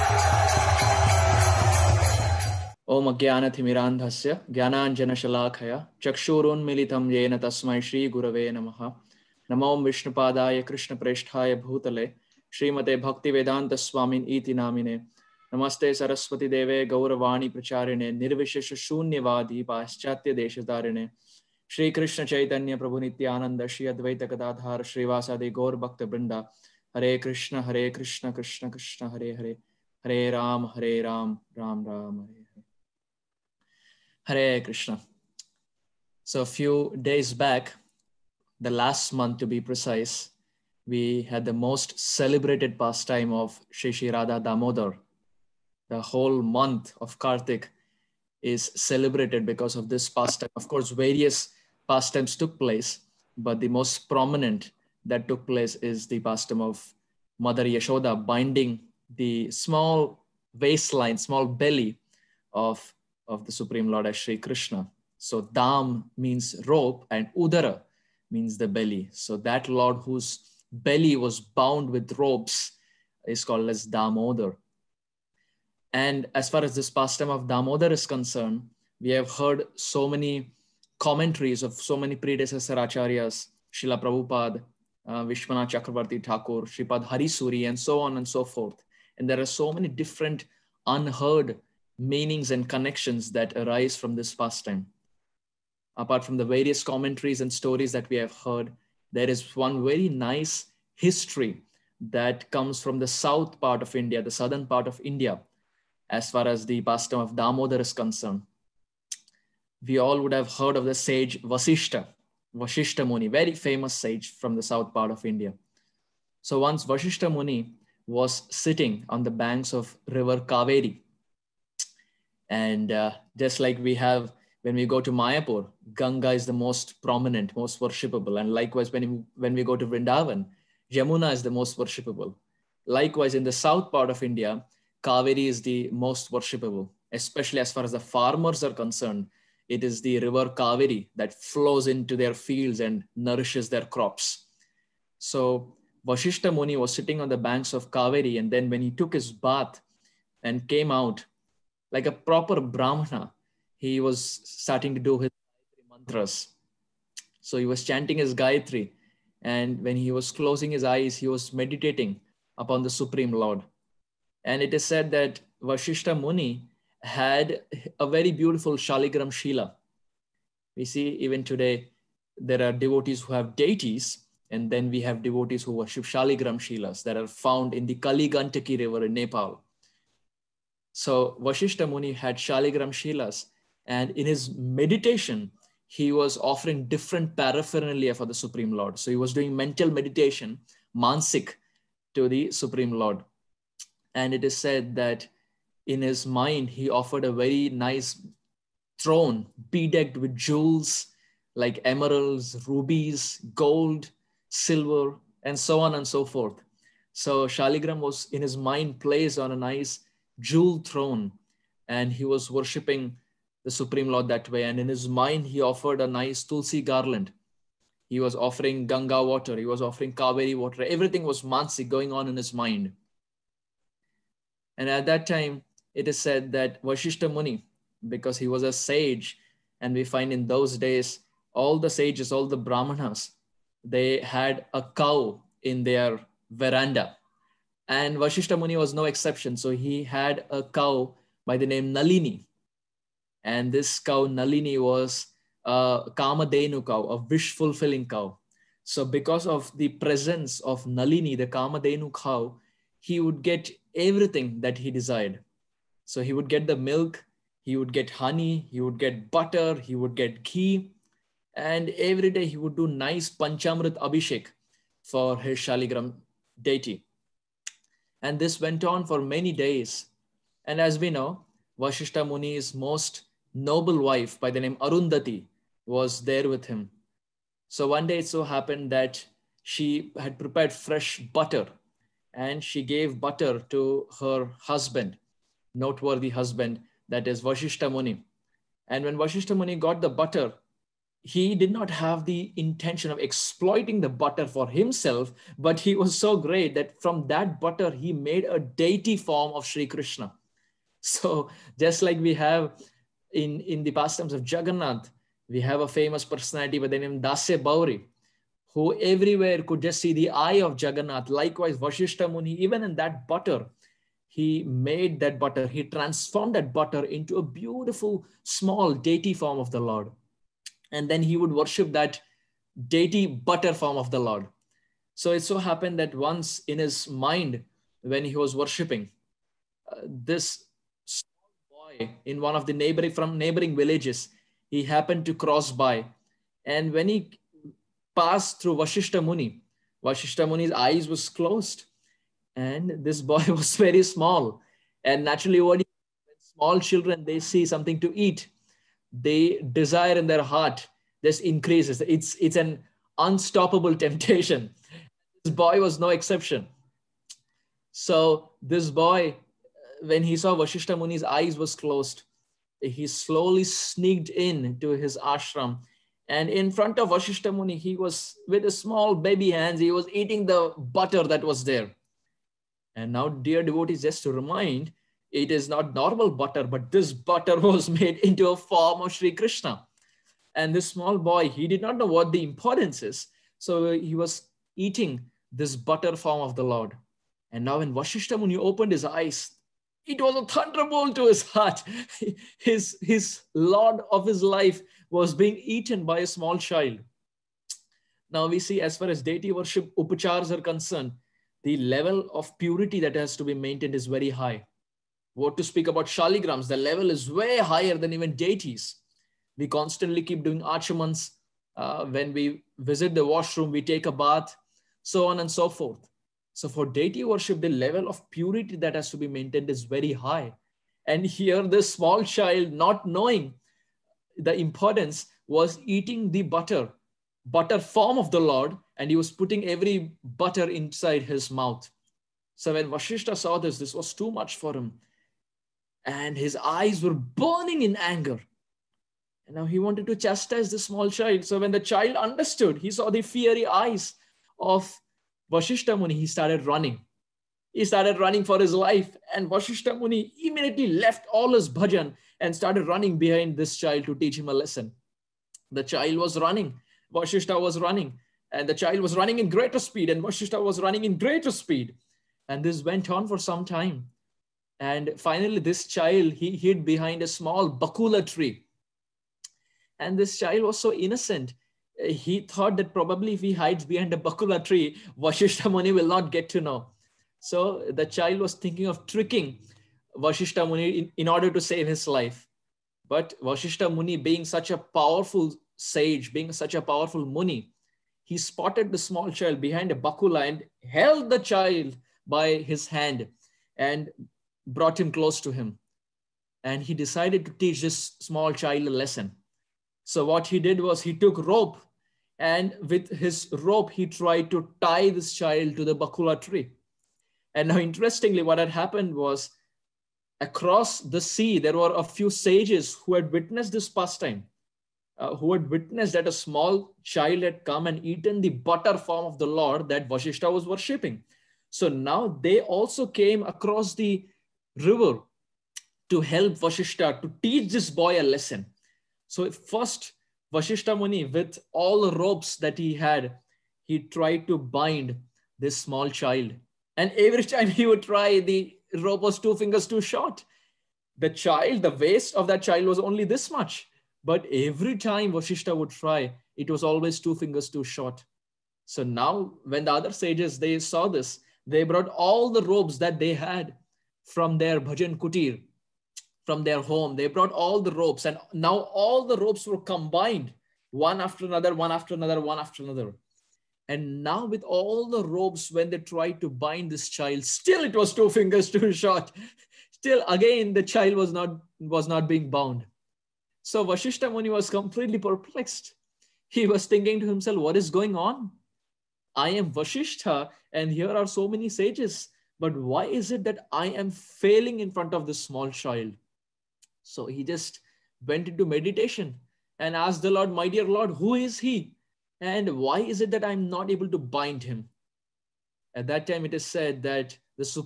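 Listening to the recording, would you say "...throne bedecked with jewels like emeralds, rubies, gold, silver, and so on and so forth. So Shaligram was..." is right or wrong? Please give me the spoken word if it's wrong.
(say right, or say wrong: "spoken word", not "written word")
right.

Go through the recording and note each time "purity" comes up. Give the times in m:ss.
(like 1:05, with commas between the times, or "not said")
6:42, 6:58.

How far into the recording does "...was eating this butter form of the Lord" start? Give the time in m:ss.
6:24.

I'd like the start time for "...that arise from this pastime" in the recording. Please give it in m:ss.
1:33.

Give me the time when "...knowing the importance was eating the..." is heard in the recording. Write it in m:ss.
7:03.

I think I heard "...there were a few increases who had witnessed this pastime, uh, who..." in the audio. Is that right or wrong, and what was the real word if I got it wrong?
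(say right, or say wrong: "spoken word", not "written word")
wrong: "sages", not "increases".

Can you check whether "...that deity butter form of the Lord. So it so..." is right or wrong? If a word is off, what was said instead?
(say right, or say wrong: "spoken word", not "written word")
right.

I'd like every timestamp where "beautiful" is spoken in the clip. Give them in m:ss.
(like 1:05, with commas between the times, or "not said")
2:48, 5:17.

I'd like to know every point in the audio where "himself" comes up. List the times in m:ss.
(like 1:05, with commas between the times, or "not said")
4:54, 9:37.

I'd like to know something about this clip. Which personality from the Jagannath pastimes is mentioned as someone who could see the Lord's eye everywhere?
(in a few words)
Dasya Bauri.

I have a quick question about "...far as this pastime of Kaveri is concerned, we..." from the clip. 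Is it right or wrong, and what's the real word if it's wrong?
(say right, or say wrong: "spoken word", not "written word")
wrong: "Damodar", not "Kaveri".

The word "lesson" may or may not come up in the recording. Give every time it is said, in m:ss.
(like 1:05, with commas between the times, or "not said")
7:34, 8:18, 8:48.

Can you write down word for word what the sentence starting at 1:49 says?
We all would have heard of the sage Vasishta, Vasishta Muni, very famous sage from the south part of India.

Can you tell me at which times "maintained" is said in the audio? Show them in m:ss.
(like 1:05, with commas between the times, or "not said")
6:43, 6:59.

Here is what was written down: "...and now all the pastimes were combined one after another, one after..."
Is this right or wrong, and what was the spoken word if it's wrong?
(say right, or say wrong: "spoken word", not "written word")
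wrong: "robes", not "pastimes".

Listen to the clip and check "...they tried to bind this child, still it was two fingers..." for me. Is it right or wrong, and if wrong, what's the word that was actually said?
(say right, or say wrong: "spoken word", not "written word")
right.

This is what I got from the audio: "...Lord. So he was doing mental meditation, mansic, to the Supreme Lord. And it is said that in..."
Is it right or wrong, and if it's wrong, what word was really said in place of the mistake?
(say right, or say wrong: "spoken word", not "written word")
right.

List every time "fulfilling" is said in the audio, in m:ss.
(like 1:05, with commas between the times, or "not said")
4:07.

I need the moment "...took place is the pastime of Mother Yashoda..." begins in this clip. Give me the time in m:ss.
0:55.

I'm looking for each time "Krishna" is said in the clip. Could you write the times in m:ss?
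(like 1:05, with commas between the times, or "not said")
1:04, 4:59, 6:19.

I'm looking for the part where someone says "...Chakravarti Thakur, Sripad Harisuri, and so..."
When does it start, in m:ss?
1:25.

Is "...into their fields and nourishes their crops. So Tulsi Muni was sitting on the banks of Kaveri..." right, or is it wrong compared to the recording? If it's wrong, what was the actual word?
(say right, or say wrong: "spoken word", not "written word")
wrong: "Vashishta", not "Tulsi".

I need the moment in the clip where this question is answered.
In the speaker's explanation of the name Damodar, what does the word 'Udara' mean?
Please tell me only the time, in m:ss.
1:07.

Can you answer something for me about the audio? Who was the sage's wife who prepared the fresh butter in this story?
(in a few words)
Arundhati.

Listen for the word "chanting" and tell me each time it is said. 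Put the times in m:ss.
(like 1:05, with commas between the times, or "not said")
2:37.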